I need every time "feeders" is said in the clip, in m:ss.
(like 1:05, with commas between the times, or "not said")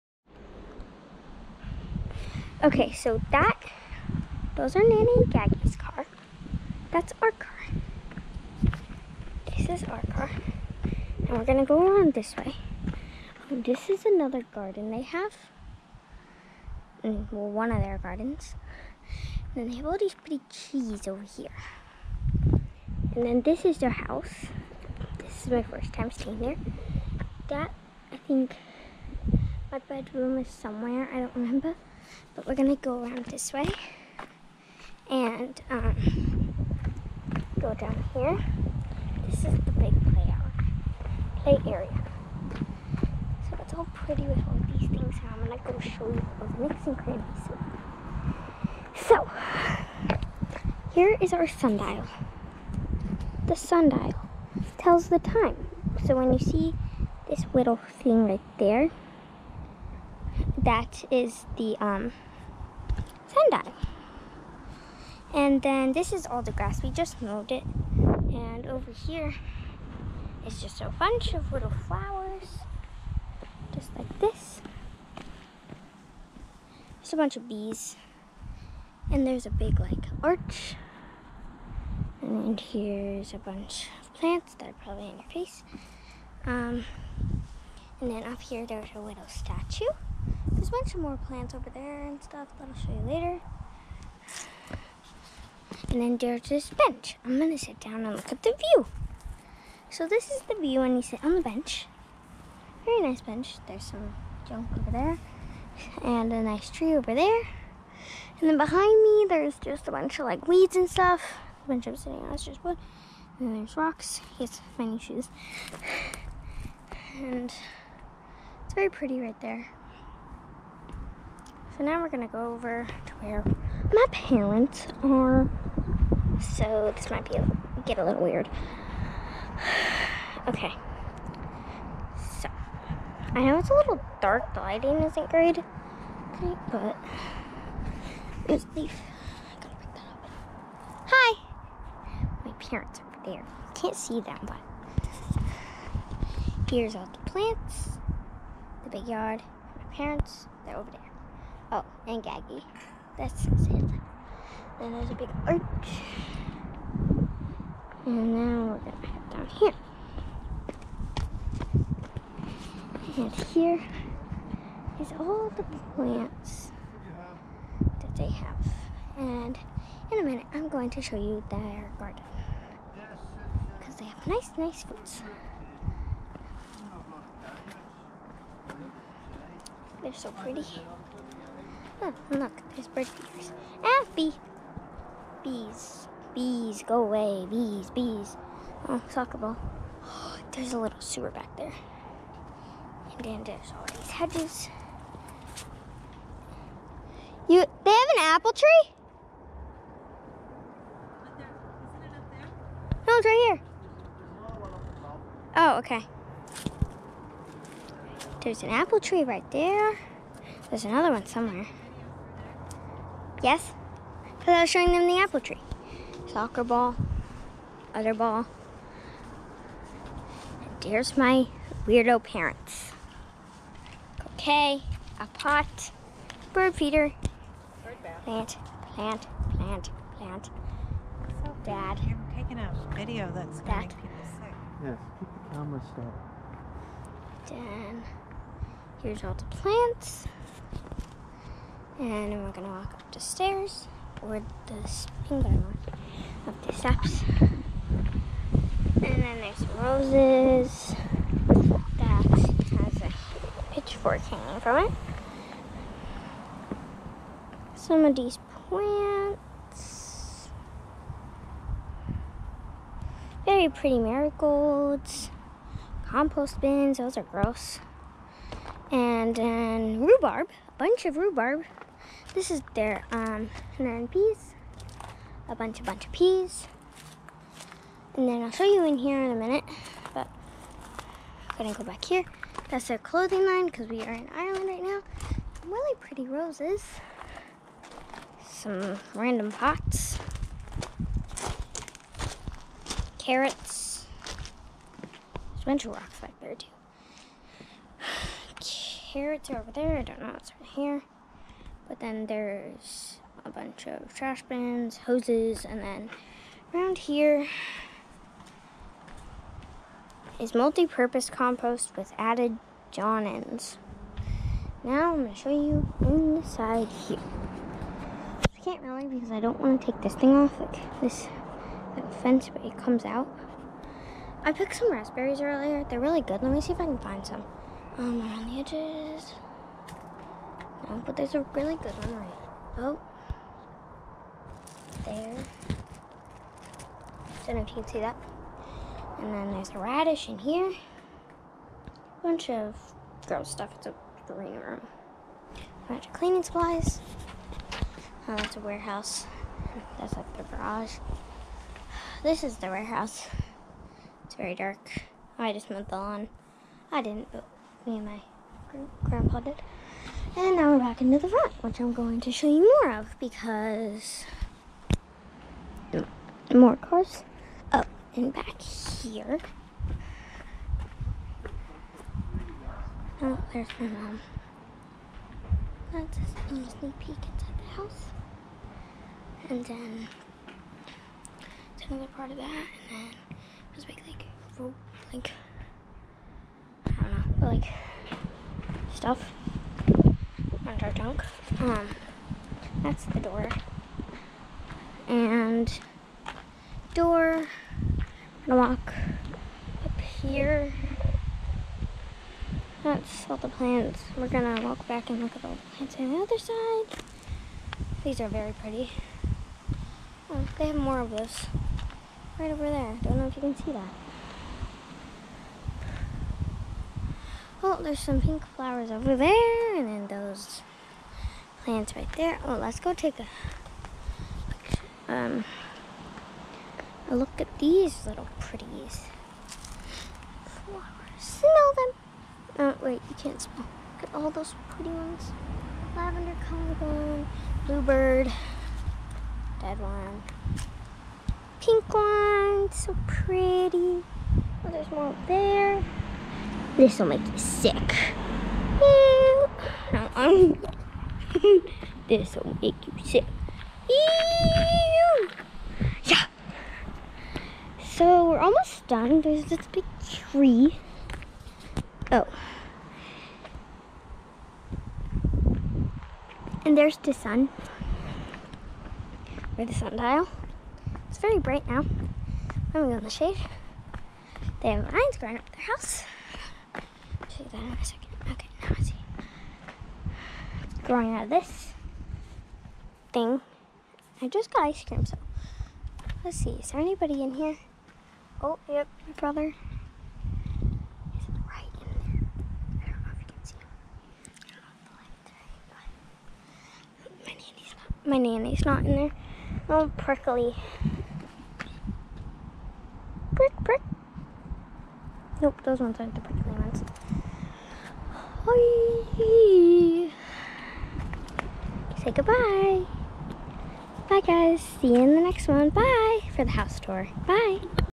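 3:03, 3:46.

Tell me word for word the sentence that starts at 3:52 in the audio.
You're taking a video that's going Dad.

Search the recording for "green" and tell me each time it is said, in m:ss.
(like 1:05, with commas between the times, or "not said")
5:44.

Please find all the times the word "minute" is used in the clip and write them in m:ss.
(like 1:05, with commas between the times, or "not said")
2:50, 4:39.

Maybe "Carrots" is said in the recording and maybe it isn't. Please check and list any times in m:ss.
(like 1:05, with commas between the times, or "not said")
4:53, 4:58.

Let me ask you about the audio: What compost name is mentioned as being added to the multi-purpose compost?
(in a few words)
John Innes.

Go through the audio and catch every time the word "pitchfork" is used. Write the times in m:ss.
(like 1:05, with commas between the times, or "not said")
4:13.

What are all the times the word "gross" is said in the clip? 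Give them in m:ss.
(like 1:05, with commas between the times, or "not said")
4:27, 5:43.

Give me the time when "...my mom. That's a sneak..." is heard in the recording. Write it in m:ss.
6:13.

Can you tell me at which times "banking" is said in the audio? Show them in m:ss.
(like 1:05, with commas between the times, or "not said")
not said.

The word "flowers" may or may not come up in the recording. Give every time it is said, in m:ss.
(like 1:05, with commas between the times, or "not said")
1:11, 6:58, 7:10.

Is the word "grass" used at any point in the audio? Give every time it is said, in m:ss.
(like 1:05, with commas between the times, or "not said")
1:06.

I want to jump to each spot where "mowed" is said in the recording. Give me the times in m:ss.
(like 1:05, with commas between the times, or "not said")
1:07, 5:55.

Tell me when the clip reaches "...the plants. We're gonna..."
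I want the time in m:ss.
6:43.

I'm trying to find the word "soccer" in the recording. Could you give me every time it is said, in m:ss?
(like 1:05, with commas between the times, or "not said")
3:09, 3:36.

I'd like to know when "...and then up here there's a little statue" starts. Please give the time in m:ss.
1:28.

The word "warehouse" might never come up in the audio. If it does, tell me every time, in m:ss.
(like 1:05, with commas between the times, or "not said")
5:48, 5:52.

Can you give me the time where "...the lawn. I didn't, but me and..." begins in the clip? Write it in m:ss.
5:55.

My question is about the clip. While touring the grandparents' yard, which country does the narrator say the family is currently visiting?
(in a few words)
Ireland.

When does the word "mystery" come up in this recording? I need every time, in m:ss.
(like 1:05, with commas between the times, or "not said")
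not said.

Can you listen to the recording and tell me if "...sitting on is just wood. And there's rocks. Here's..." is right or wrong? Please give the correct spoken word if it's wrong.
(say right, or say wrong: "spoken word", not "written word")
right.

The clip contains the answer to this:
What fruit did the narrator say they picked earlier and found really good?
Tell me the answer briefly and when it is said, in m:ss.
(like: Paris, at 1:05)
Raspberries, at 5:24.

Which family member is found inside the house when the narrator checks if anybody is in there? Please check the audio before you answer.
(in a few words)
Brother.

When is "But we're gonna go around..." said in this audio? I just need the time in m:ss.
0:32.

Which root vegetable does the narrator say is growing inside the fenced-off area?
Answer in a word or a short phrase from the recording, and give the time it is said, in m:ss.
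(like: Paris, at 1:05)
Radish, at 5:39.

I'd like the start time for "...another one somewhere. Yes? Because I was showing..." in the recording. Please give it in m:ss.
3:30.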